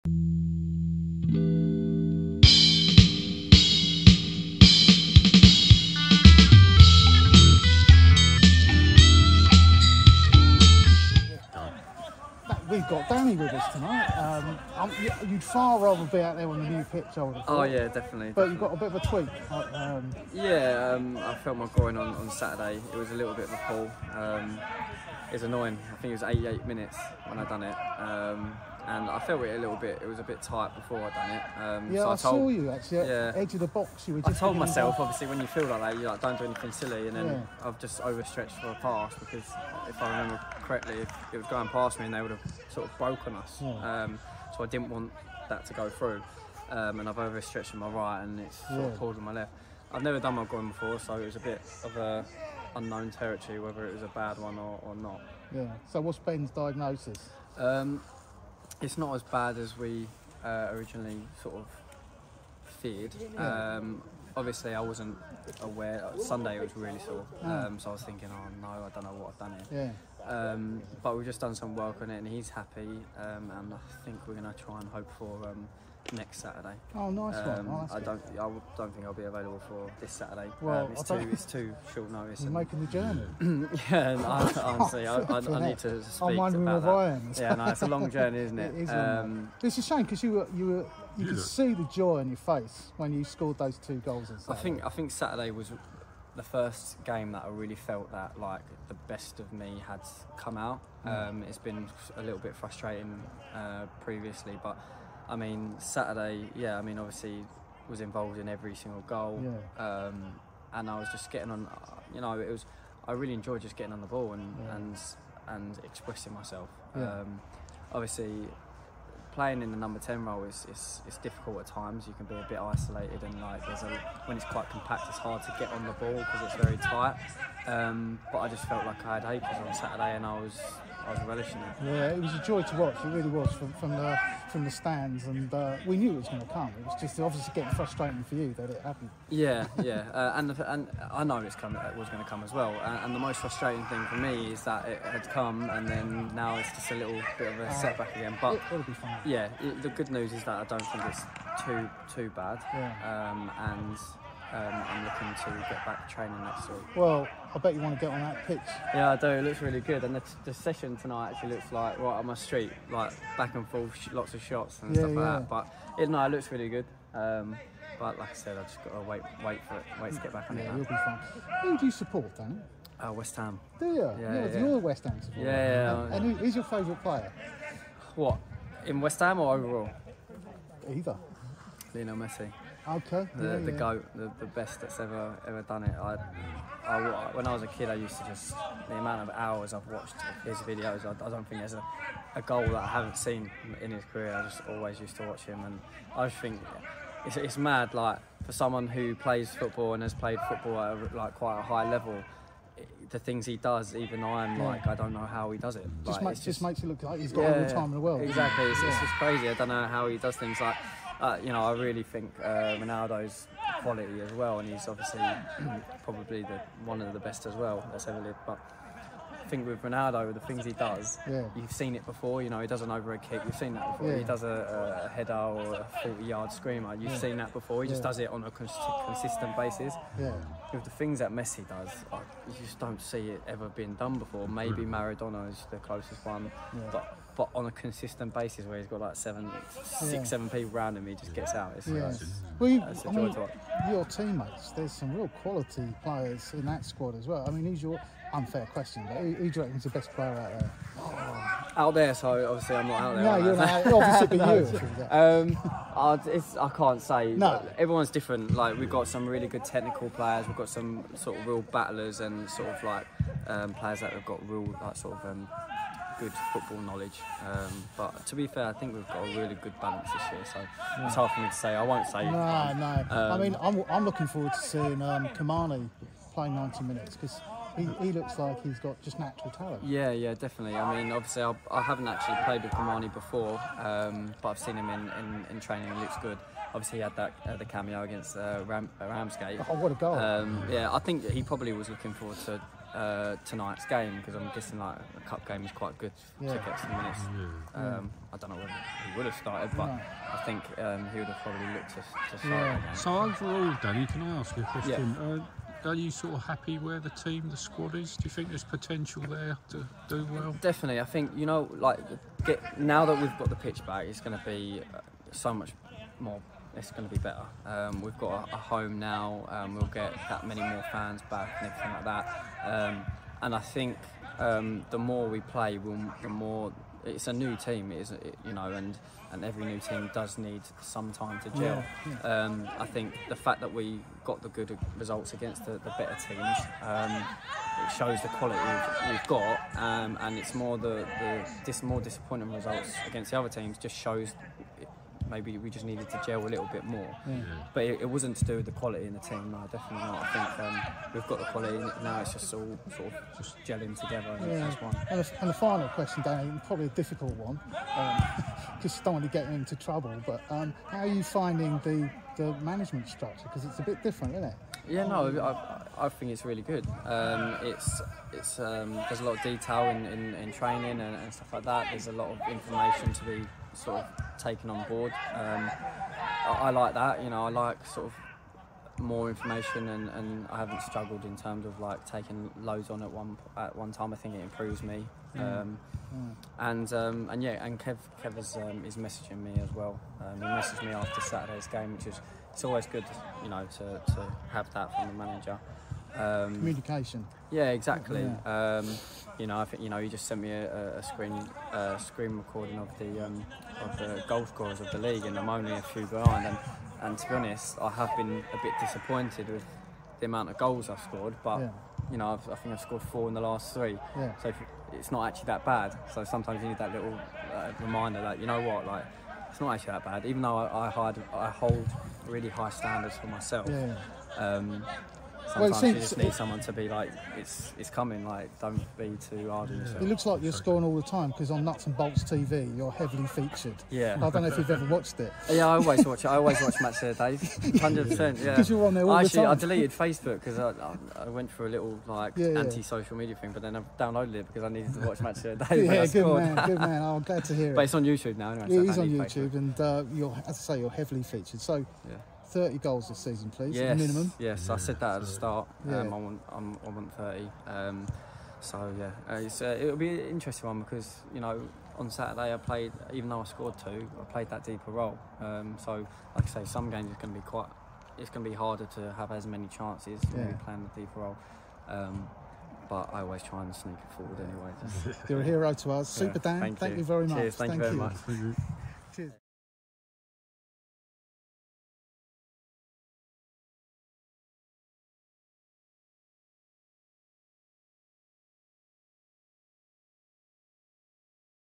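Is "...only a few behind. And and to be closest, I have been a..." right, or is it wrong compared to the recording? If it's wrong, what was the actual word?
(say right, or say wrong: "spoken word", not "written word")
wrong: "honest", not "closest".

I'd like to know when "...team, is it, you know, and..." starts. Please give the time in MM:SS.
05:27.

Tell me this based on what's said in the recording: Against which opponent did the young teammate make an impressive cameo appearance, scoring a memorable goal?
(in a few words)
Ramsgate.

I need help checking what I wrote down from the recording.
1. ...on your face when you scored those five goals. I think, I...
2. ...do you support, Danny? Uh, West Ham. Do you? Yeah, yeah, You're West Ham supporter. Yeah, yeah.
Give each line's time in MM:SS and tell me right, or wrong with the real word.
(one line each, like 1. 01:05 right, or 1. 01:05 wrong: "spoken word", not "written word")
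1. 01:32 wrong: "two", not "five"
2. 02:51 right.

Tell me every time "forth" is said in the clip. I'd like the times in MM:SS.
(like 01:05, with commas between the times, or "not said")
02:43.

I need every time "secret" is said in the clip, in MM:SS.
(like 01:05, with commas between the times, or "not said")
not said.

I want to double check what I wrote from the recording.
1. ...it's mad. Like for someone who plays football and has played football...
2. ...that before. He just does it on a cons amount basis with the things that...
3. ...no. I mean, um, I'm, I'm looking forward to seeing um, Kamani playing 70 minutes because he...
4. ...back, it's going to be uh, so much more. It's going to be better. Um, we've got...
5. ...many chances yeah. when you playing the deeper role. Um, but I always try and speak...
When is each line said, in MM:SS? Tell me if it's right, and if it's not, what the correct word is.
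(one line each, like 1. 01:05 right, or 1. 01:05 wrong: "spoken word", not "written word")
1. 03:17 right
2. 03:47 wrong: "consistent", not "amount"
3. 04:32 wrong: "90", not "70"
4. 05:13 right
5. 07:49 wrong: "sneak", not "speak".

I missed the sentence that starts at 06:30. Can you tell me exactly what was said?
Um, he messaged me after Saturday's game, which is it's always good, you know, to, to have that from the manager.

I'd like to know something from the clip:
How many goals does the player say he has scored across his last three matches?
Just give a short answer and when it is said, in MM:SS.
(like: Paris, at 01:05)
4, at 06:53.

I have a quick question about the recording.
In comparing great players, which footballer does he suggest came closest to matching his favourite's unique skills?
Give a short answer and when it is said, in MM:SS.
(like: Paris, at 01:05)
Maradona, at 03:54.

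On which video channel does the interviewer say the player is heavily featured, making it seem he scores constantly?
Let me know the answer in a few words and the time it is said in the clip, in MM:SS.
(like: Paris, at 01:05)
Nuts and Bolts TV, at 07:11.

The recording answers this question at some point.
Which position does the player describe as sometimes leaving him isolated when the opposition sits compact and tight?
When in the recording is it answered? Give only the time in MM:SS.
01:59.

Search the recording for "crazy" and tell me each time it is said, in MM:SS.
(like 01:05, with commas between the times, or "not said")
03:29.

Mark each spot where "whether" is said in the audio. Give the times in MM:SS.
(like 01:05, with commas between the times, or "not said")
00:53, 04:58.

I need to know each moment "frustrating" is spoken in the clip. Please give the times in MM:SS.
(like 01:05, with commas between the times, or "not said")
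01:42, 02:17, 02:23.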